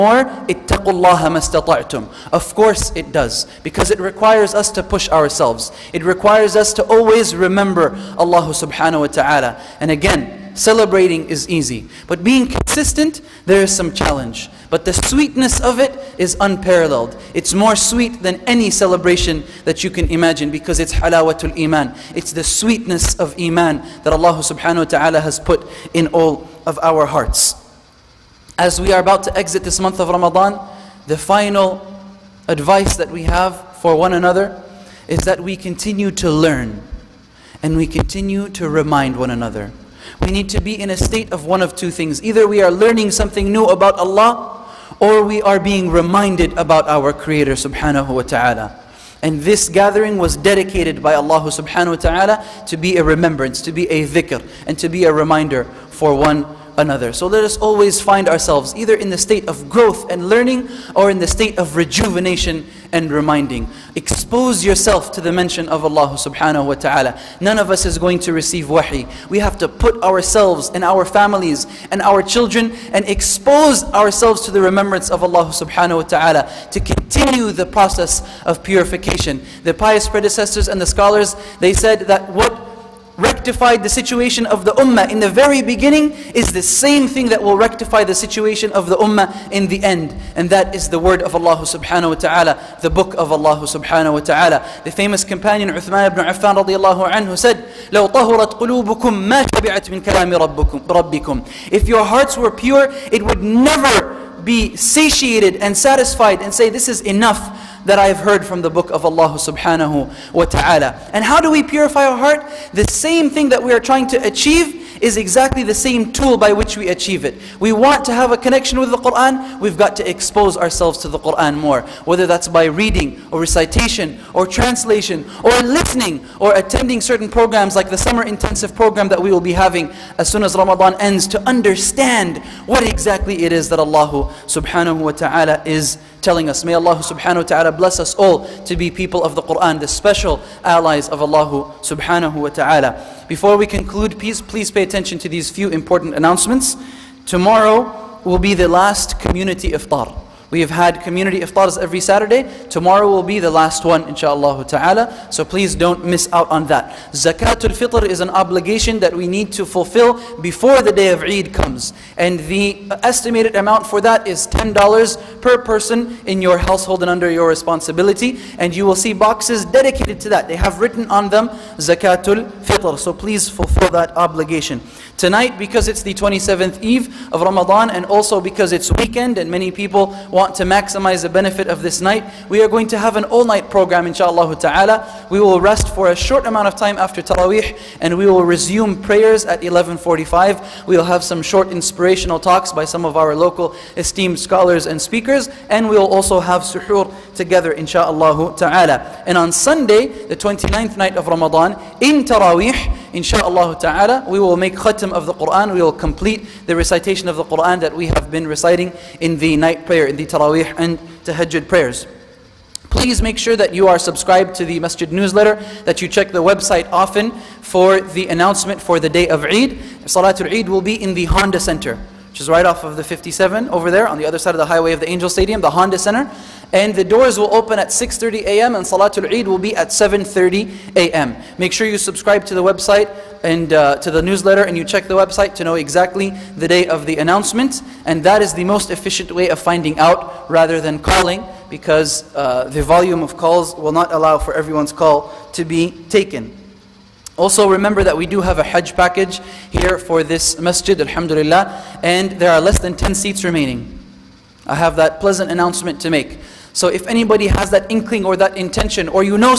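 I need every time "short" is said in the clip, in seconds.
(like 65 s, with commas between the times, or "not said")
186 s, 191 s.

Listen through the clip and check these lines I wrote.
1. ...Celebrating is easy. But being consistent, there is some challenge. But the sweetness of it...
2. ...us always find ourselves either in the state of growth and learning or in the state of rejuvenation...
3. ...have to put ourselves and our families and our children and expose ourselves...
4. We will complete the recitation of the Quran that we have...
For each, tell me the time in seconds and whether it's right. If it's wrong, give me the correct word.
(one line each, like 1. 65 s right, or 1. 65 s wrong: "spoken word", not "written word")
1. 10 s right
2. 57 s right
3. 69 s right
4. 205 s right.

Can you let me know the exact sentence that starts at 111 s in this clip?
And how do we purify our heart?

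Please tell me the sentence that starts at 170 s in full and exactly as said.
They have written on them Zakatul fitr.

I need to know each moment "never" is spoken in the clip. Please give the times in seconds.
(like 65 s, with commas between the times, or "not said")
103 s.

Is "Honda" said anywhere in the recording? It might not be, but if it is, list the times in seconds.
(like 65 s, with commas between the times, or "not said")
221 s, 225 s.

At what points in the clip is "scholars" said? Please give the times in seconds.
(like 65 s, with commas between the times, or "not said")
80 s, 194 s.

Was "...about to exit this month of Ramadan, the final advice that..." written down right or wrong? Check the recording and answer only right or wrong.
right.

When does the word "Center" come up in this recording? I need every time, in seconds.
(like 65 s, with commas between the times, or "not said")
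221 s, 225 s.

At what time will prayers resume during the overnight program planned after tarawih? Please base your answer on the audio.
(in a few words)
11:45.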